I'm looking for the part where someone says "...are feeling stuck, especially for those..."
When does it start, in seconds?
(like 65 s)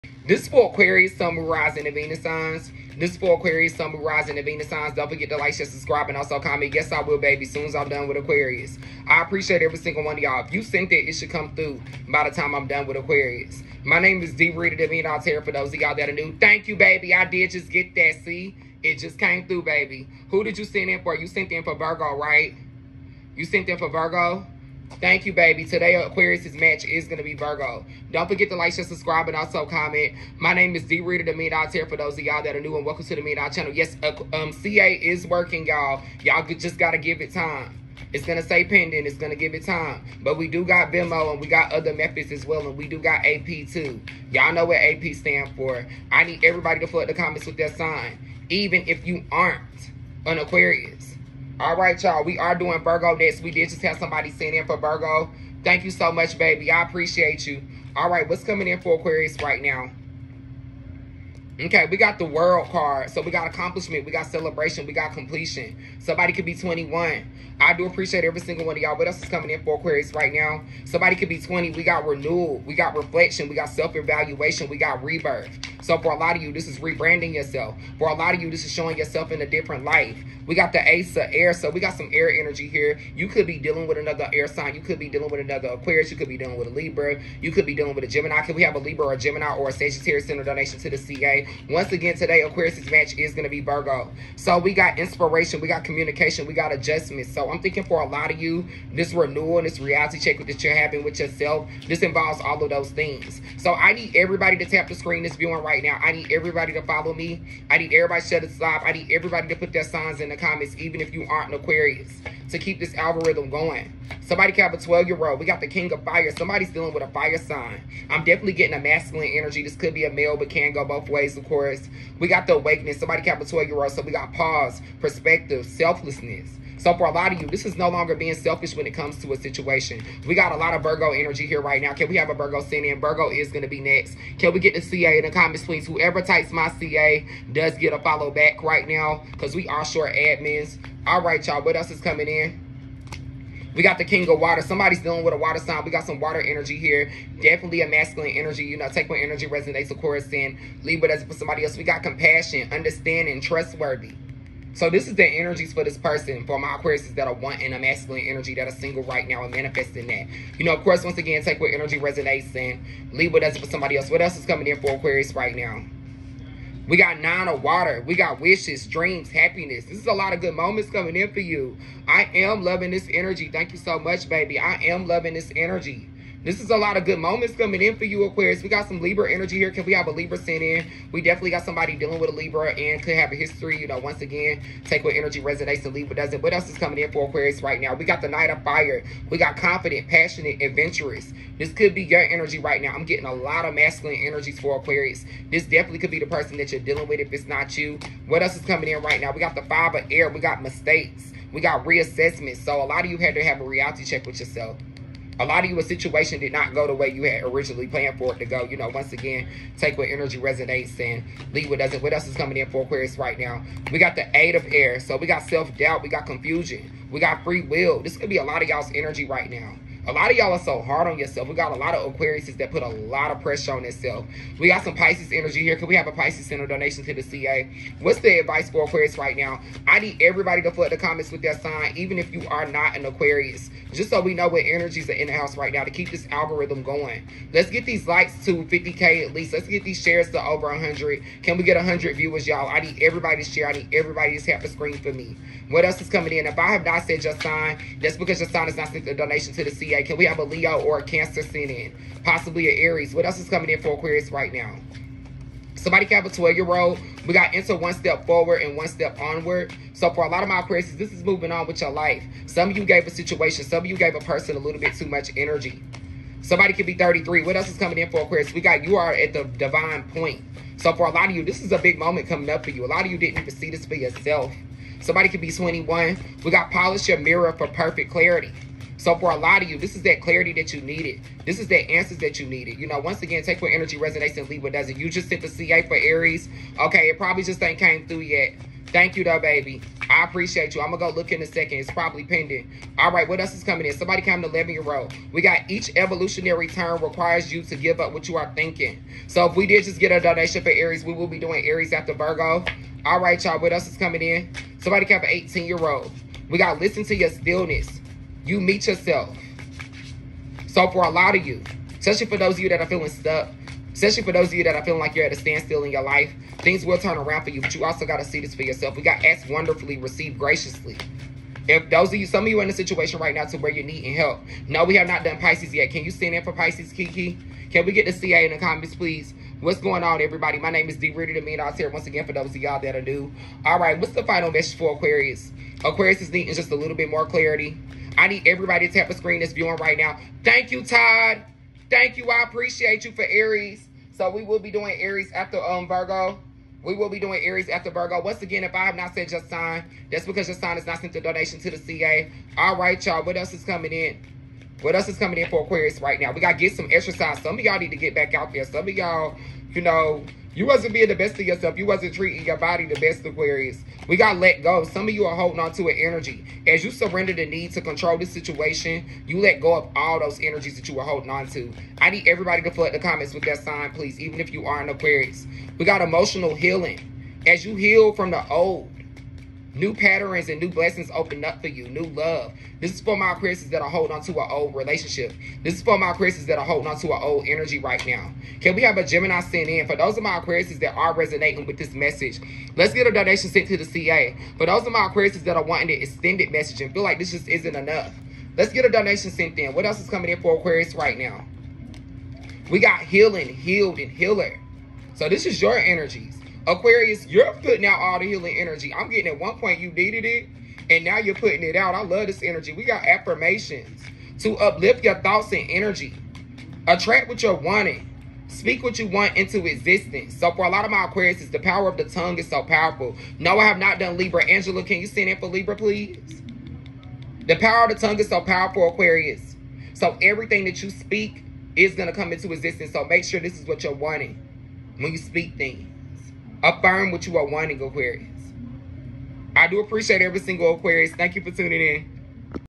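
312 s.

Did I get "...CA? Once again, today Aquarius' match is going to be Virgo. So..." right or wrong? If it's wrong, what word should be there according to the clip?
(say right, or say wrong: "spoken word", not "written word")
right.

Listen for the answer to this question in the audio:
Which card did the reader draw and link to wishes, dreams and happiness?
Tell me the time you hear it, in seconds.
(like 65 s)
167 s.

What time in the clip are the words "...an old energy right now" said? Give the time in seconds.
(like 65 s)
387 s.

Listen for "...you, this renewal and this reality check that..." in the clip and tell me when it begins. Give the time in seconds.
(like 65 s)
98 s.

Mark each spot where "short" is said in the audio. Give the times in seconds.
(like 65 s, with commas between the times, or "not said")
139 s.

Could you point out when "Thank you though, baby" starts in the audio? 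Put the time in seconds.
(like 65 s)
288 s.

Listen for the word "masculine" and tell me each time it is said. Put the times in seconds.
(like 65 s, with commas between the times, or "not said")
118 s, 147 s, 157 s, 193 s.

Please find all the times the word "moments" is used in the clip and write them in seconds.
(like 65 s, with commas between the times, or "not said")
170 s, 177 s, 271 s.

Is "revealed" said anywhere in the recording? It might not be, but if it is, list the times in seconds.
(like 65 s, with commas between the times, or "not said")
not said.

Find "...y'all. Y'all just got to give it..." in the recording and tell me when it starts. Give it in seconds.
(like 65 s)
35 s.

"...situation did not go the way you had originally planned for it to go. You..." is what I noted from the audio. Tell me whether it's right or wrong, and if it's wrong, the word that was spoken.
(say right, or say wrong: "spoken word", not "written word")
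right.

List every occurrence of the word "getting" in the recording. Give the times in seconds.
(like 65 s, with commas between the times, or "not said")
118 s, 193 s, 409 s.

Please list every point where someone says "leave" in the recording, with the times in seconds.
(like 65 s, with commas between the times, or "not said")
150 s, 163 s, 185 s, 211 s, 284 s.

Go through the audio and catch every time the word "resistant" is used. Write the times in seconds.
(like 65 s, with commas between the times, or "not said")
not said.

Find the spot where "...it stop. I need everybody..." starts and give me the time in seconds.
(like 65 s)
108 s.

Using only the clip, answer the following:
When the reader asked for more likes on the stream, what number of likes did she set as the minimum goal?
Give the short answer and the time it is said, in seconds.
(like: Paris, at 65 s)
50K, at 238 s.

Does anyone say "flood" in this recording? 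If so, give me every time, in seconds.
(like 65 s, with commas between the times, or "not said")
46 s, 230 s, 372 s.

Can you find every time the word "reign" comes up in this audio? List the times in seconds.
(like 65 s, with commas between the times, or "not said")
not said.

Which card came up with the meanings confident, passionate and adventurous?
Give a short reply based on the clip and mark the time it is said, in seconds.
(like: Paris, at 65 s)
Knight of Fire, at 188 s.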